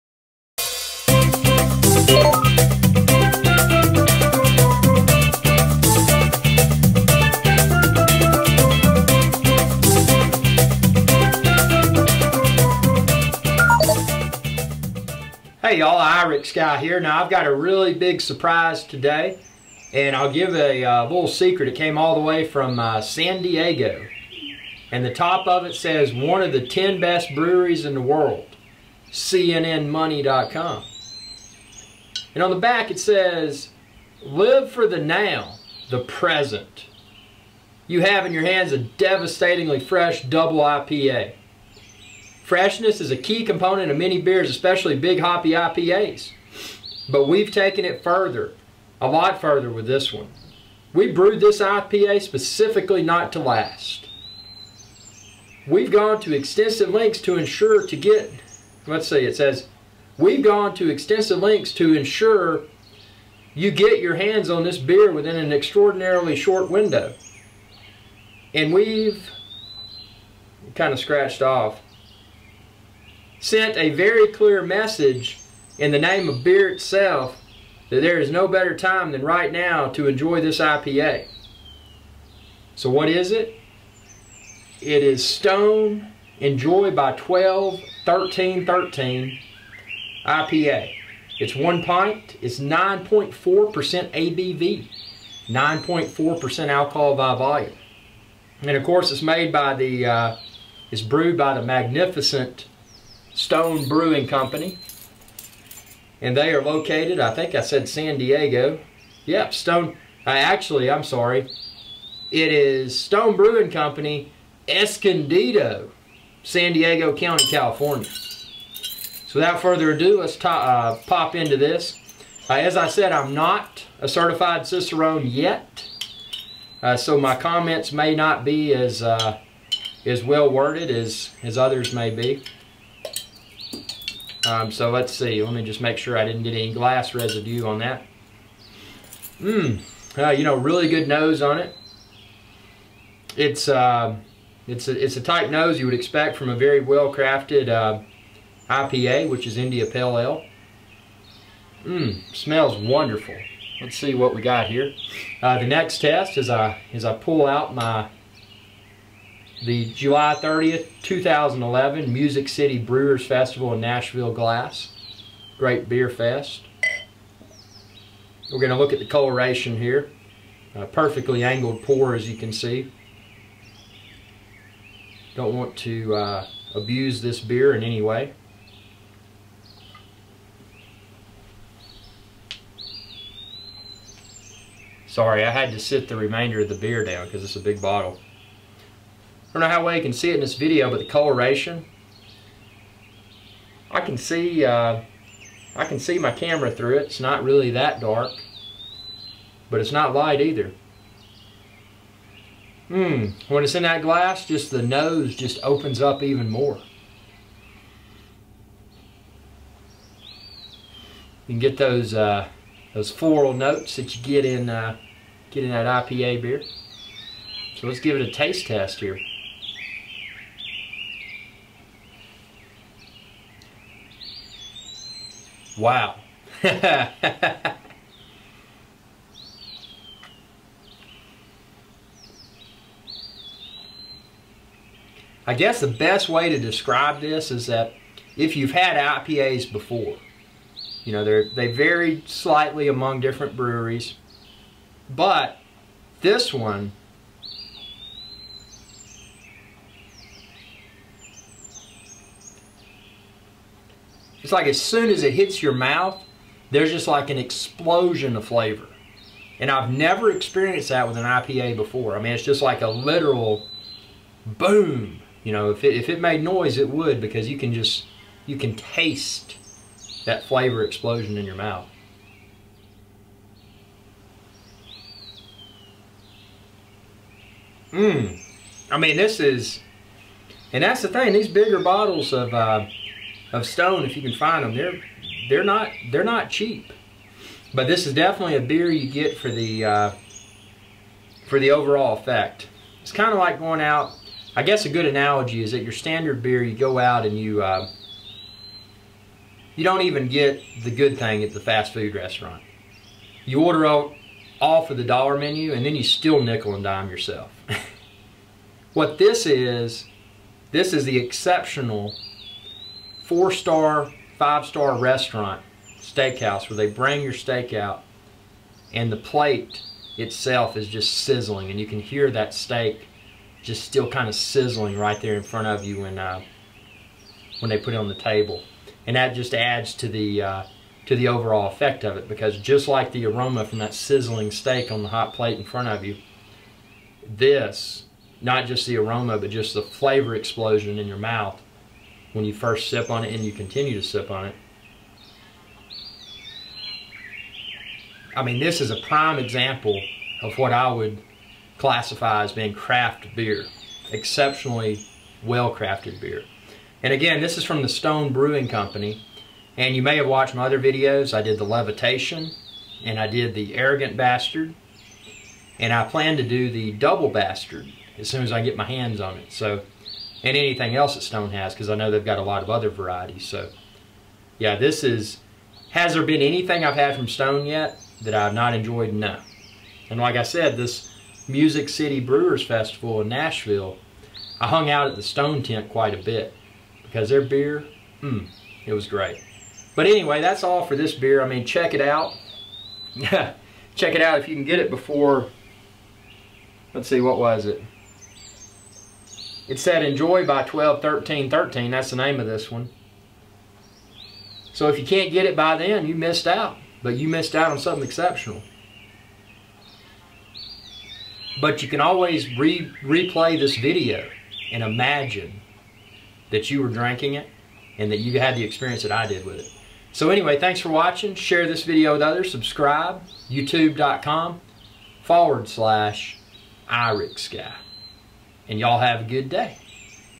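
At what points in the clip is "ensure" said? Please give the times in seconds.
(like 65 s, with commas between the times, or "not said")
57 s, 61 s.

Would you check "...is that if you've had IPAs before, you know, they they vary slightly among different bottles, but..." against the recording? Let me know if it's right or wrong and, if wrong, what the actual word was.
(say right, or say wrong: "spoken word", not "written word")
wrong: "breweries", not "bottles".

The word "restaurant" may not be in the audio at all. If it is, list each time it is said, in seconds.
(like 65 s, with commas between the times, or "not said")
302 s, 314 s.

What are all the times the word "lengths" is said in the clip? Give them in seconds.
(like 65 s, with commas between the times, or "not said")
56 s, 61 s.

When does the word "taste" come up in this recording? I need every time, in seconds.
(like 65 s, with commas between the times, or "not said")
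218 s, 268 s.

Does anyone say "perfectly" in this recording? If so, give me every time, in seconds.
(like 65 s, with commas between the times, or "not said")
170 s.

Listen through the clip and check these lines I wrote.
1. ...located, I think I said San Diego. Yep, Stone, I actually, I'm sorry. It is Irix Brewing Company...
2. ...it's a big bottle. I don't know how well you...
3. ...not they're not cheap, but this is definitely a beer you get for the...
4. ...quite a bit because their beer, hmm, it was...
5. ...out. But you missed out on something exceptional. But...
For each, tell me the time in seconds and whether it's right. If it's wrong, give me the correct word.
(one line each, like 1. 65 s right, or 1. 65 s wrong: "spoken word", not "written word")
1. 106 s wrong: "Stone", not "Irix"
2. 187 s right
3. 285 s right
4. 385 s right
5. 406 s right.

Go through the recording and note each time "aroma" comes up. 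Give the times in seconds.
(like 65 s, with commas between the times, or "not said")
333 s, 338 s.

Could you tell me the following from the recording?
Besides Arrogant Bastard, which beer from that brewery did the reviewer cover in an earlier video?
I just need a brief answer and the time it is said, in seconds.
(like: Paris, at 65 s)
Levitation, at 361 s.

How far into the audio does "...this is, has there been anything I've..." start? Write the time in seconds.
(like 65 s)
374 s.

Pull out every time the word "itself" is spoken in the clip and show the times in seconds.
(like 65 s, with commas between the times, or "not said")
76 s, 320 s.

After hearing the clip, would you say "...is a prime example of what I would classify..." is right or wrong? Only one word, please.
right.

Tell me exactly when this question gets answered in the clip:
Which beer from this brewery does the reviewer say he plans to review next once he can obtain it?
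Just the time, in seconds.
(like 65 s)
366 s.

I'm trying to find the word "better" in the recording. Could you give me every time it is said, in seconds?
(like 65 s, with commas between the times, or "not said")
78 s.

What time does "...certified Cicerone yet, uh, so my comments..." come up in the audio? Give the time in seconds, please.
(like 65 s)
124 s.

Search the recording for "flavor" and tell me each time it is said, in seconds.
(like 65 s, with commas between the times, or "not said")
258 s, 270 s, 339 s.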